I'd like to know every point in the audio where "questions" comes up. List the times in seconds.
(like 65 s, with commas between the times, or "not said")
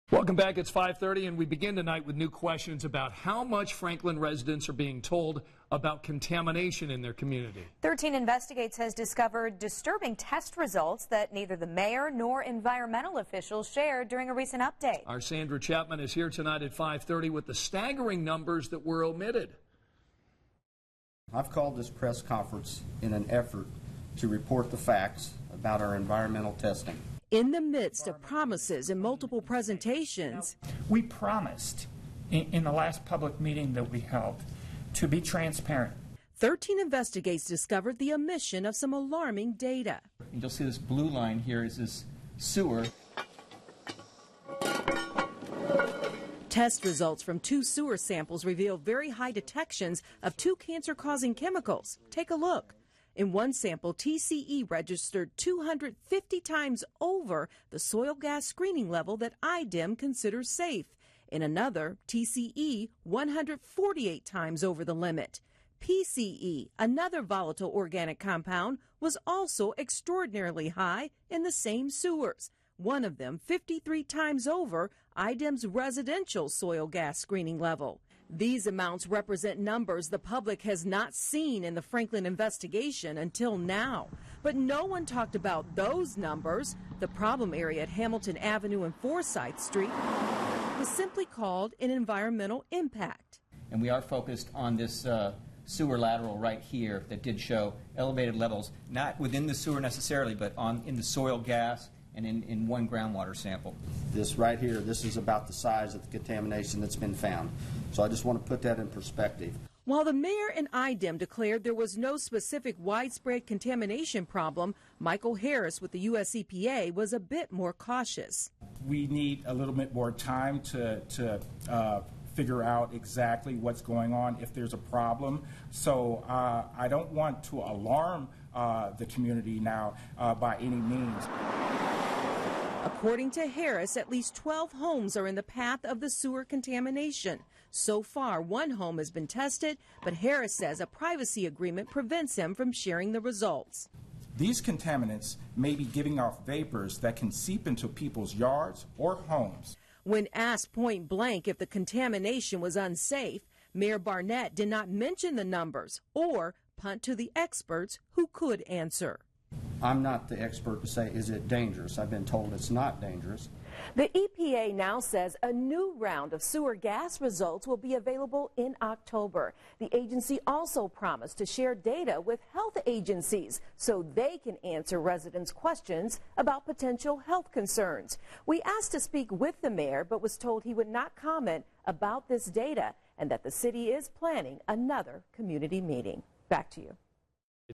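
2 s, 175 s.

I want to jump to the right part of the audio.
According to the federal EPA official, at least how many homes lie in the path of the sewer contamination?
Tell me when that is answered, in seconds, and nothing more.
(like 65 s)
134 s.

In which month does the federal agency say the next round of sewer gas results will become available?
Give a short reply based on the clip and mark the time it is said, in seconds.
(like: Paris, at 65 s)
October, at 168 s.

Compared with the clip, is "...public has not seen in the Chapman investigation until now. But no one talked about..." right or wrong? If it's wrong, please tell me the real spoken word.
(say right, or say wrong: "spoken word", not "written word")
wrong: "Franklin", not "Chapman".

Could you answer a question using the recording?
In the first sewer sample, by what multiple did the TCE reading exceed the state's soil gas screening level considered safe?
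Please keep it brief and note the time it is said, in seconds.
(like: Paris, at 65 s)
250 times, at 55 s.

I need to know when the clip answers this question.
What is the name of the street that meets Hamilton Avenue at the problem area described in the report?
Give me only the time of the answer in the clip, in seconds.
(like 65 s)
88 s.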